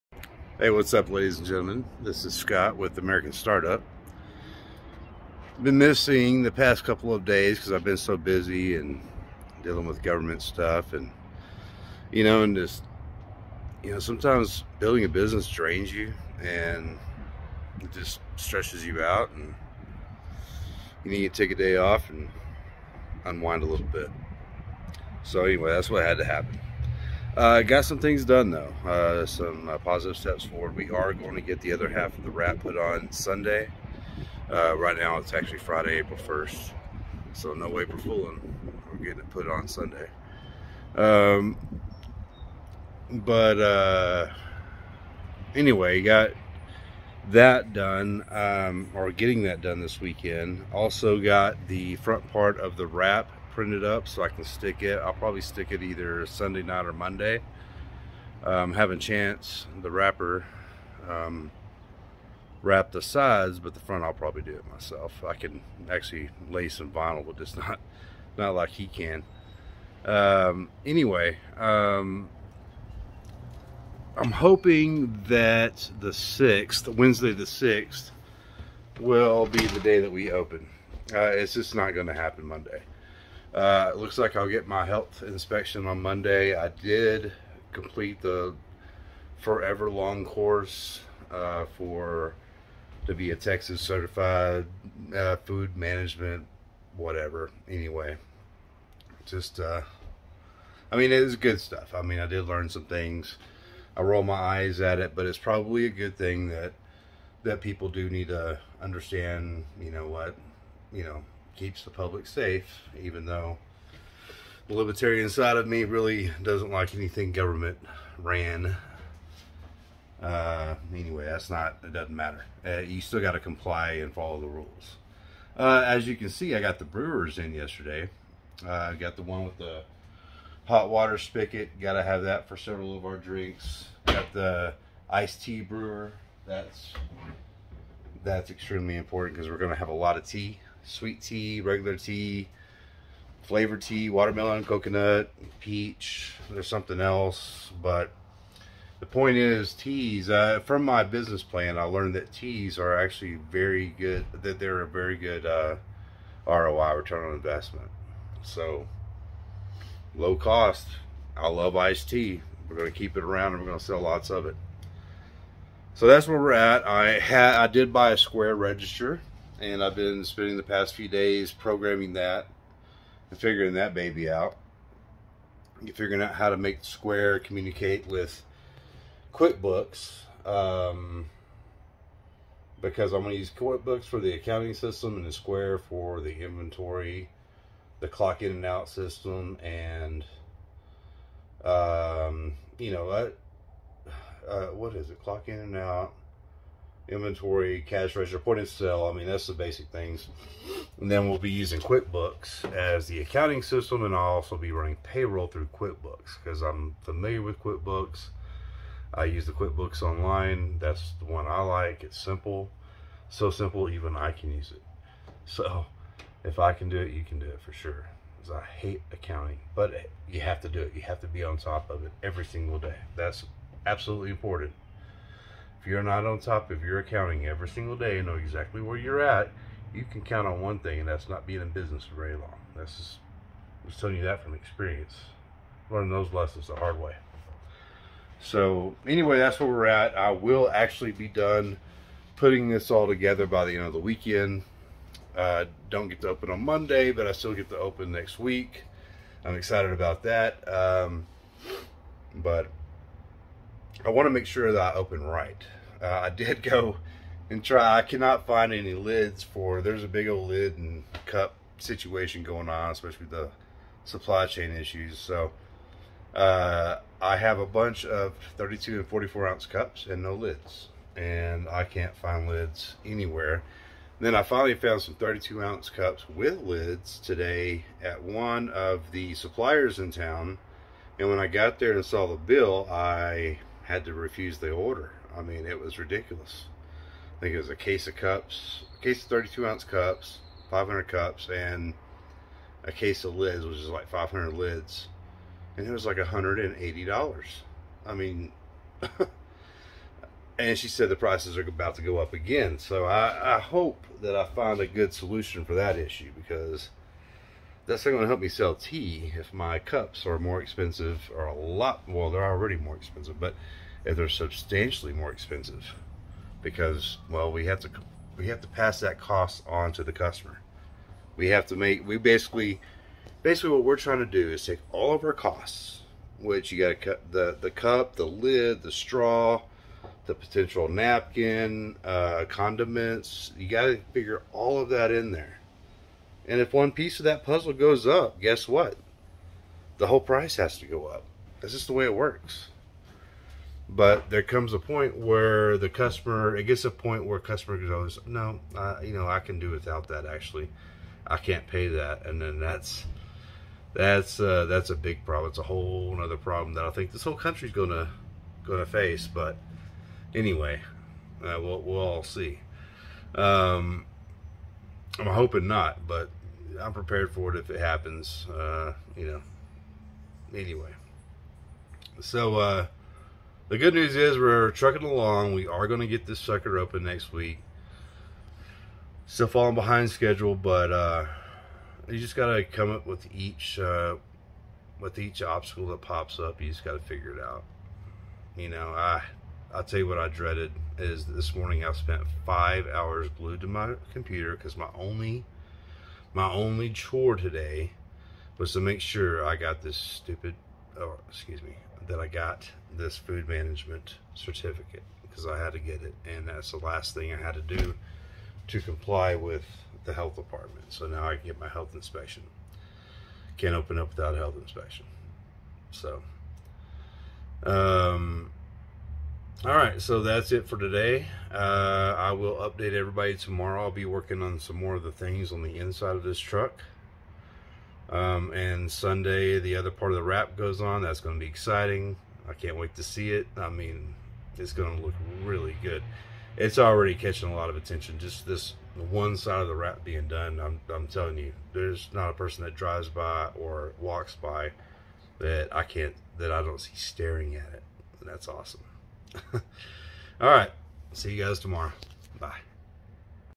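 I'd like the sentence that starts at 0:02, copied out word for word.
This is Scott with American Startup.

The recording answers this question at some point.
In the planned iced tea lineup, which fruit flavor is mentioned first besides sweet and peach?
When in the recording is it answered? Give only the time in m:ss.
2:24.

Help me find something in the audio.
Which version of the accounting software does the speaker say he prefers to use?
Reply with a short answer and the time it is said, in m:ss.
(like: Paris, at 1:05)
QuickBooks Online, at 3:29.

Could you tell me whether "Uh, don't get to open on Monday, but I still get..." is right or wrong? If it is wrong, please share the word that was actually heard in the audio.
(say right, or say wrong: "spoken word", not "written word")
right.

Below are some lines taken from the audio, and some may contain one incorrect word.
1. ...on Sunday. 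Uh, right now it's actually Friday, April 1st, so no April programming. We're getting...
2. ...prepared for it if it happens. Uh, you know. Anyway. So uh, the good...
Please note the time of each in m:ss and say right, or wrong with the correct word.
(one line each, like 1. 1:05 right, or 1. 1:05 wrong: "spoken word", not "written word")
1. 0:32 wrong: "fooling", not "programming"
2. 6:06 right.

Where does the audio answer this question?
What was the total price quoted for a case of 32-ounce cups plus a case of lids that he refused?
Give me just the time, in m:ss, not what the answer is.
4:56.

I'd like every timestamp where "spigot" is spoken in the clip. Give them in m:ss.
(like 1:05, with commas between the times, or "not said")
2:11.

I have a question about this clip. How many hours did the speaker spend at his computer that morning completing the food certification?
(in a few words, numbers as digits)
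5.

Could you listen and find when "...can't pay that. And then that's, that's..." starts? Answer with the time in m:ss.
5:51.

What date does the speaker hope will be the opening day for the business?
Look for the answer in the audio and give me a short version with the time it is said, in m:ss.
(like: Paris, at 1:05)
Wednesday the 6th, at 1:16.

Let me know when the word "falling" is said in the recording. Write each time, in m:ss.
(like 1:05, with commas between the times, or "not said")
6:19.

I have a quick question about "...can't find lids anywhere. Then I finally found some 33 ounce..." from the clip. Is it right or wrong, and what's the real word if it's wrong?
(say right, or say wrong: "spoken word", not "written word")
wrong: "32", not "33".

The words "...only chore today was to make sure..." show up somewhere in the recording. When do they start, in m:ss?
6:36.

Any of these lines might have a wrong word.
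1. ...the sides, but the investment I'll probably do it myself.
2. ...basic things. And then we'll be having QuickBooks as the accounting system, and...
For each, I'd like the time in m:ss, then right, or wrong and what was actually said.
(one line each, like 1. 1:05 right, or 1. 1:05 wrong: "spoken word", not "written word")
1. 1:02 wrong: "front", not "investment"
2. 3:19 wrong: "using", not "having".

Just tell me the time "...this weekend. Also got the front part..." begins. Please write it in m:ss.
0:49.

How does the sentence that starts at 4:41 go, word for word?
And when I got there and saw the bill, I had to refuse the order.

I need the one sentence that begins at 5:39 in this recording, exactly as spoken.
The whole price has to go up.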